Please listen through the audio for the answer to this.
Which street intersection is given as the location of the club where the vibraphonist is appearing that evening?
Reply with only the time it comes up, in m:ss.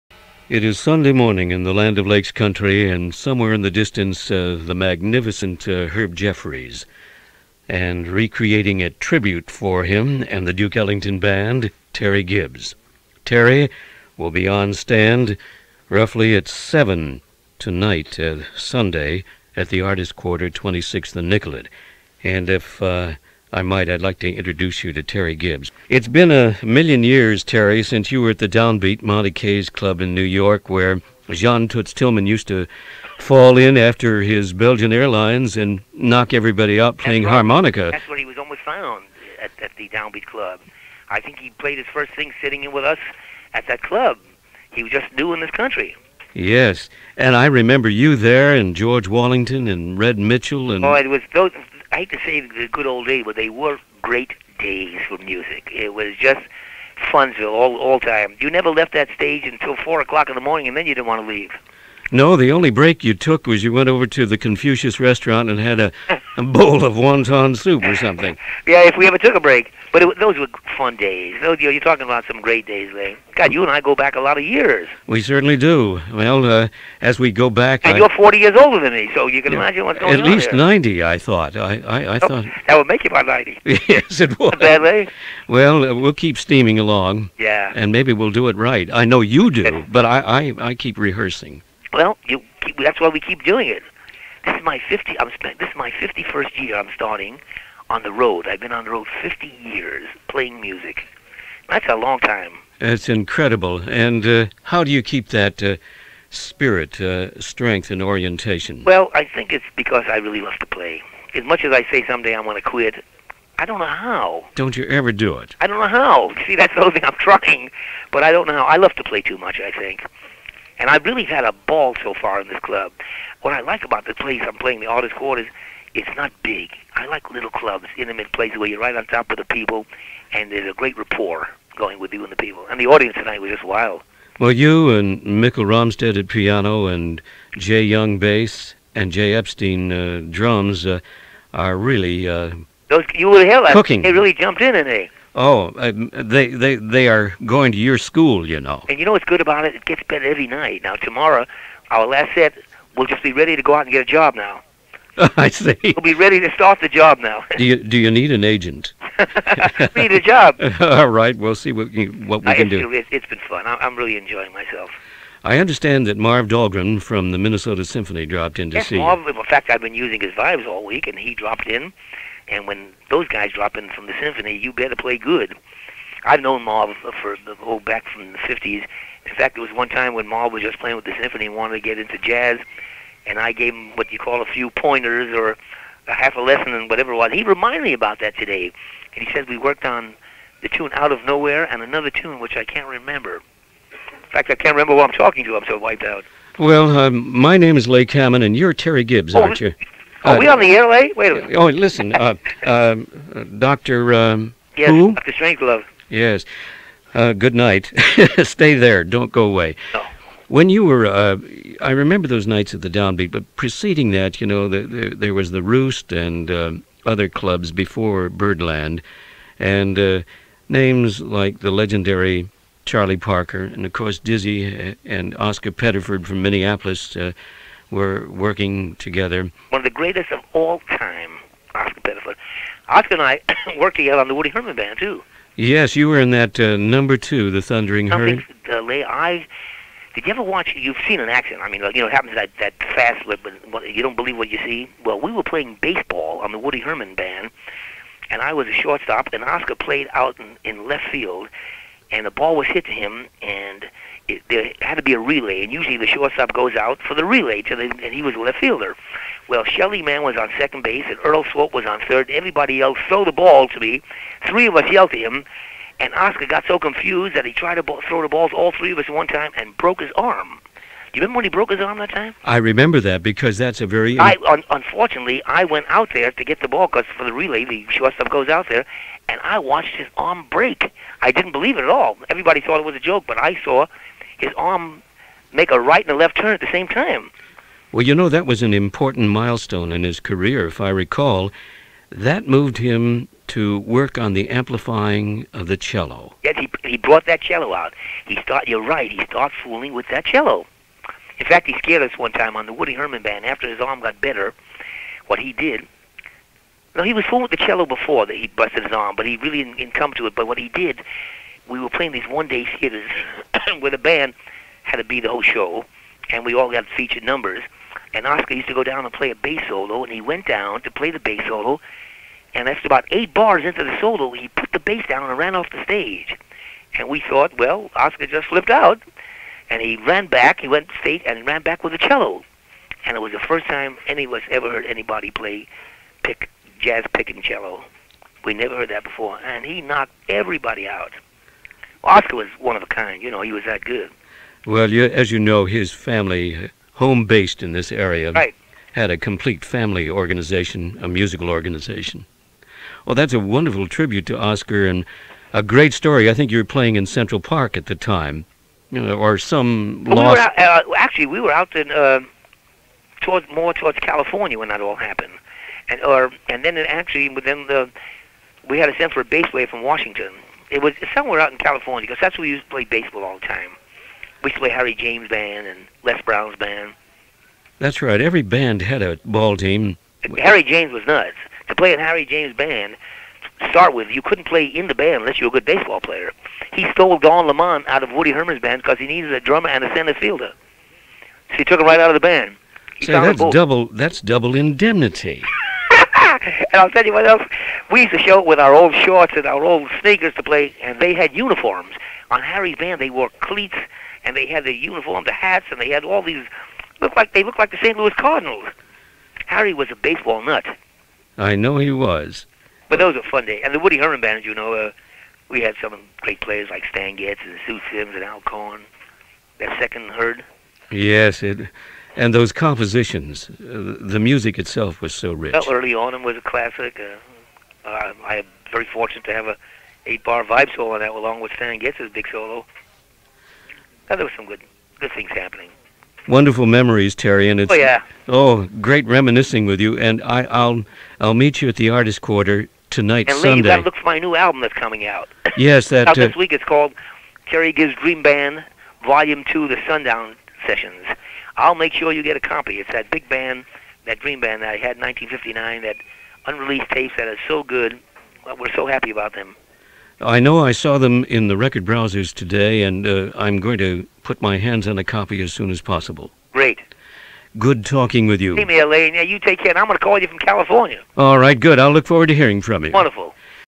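0:20.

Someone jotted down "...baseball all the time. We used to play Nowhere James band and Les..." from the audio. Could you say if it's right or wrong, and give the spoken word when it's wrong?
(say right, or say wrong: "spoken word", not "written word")
wrong: "Harry", not "Nowhere".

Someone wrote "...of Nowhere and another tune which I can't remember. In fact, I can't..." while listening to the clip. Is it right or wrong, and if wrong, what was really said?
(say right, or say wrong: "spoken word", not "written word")
right.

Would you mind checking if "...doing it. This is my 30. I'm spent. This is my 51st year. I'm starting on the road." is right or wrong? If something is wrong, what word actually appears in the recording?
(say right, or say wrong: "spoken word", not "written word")
wrong: "50", not "30".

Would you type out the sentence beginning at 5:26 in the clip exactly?
And we thought, well, Oscar just flipped out.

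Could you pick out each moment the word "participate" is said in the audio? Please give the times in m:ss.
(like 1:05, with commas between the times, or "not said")
not said.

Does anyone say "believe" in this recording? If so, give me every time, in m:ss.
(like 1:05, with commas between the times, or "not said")
4:04, 4:41.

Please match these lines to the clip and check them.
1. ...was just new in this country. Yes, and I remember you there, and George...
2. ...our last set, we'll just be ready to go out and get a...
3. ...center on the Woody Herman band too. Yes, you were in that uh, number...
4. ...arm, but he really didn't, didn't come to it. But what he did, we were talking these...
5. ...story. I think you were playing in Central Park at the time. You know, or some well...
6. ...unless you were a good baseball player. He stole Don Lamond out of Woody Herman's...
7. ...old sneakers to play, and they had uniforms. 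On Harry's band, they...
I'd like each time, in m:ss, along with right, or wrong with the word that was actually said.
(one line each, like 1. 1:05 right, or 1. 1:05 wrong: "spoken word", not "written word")
1. 0:44 right
2. 2:31 right
3. 3:53 wrong: "together", not "center"
4. 5:08 wrong: "playing", not "talking"
5. 5:55 right
6. 6:25 right
7. 6:39 right.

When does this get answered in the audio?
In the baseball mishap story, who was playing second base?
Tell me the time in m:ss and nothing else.
4:19.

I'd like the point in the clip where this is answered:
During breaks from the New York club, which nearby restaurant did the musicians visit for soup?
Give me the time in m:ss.
1:04.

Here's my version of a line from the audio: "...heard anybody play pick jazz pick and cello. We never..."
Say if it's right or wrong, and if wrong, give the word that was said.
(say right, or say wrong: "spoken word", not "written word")
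right.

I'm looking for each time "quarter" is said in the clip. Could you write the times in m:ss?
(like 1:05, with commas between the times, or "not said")
0:20, 2:05, 7:22.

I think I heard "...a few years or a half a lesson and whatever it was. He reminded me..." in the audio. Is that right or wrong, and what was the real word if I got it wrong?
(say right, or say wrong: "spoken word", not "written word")
wrong: "pointers", not "years".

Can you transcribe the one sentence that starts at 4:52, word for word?
That moved him to work on the amplifying of the cello.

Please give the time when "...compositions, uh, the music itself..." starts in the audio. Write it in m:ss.
7:02.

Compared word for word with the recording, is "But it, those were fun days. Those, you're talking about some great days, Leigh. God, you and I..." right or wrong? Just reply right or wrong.
right.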